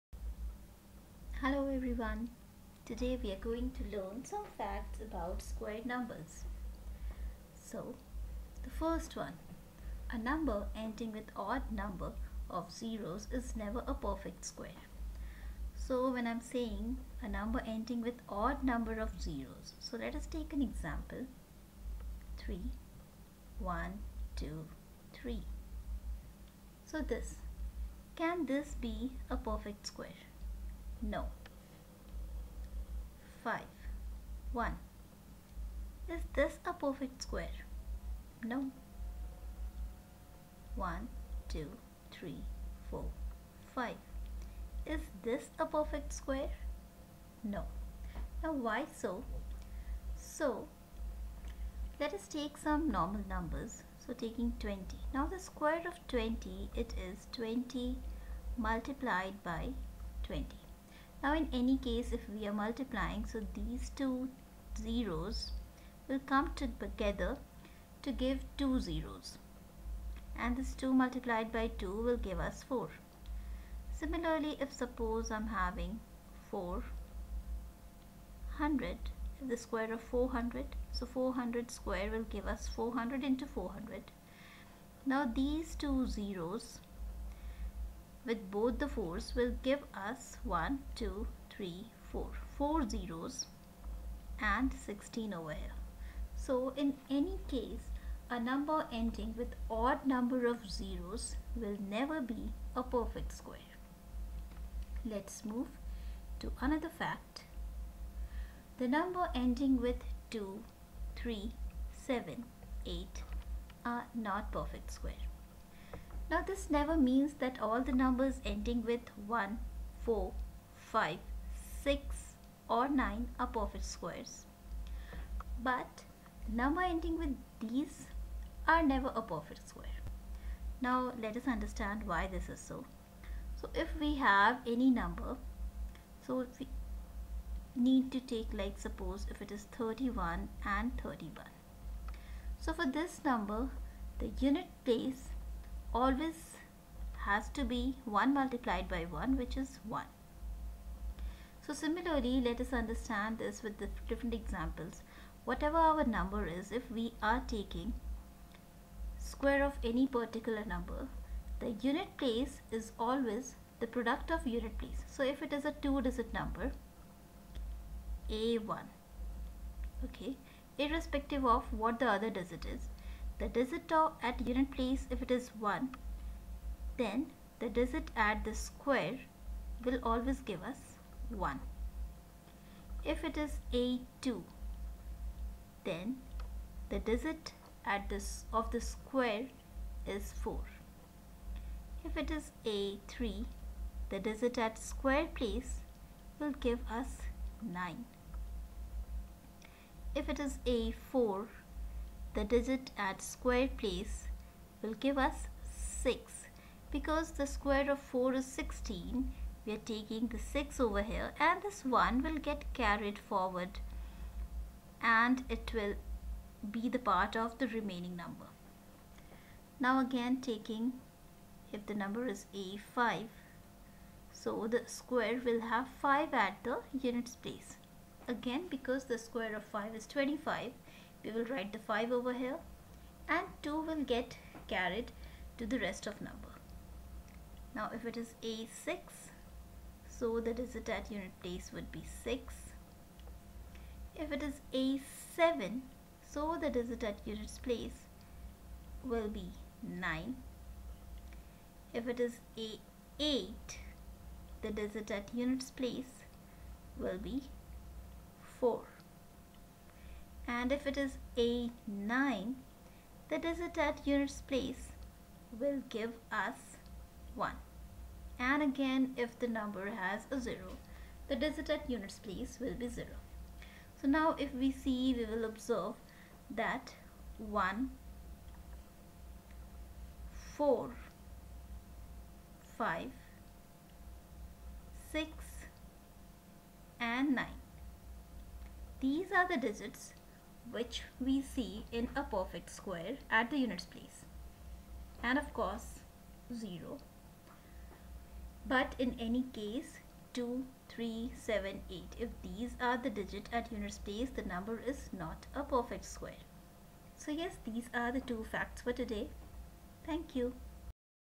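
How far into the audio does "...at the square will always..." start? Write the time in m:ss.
2:58.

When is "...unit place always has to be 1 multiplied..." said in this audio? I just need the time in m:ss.
2:24.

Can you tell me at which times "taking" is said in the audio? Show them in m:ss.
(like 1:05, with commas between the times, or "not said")
0:54, 2:37, 3:29, 3:40.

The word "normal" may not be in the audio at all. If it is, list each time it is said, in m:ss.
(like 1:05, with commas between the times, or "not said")
0:52.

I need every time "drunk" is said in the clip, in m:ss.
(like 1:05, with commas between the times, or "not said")
not said.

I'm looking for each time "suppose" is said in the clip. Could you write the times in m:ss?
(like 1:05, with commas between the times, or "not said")
1:14, 2:18.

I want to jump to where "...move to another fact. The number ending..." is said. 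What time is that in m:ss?
1:45.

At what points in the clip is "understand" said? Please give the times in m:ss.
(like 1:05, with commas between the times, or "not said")
2:11, 2:32.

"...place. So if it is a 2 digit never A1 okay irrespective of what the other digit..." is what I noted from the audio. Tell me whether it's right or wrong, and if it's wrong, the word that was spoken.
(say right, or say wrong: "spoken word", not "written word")
wrong: "number", not "never".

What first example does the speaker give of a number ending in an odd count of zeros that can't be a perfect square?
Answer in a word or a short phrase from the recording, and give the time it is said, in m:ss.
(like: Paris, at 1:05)
3000, at 0:22.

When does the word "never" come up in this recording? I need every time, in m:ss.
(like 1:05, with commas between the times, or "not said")
0:13, 1:41, 1:56, 2:08.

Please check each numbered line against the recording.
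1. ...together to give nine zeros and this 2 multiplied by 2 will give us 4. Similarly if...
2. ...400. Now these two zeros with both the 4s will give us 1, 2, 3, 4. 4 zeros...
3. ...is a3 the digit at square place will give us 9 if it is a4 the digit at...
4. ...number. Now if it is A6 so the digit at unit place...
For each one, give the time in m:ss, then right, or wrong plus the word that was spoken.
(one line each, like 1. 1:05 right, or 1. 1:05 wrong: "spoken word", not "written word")
1. 1:06 wrong: "two", not "nine"
2. 1:23 right
3. 3:12 right
4. 3:56 right.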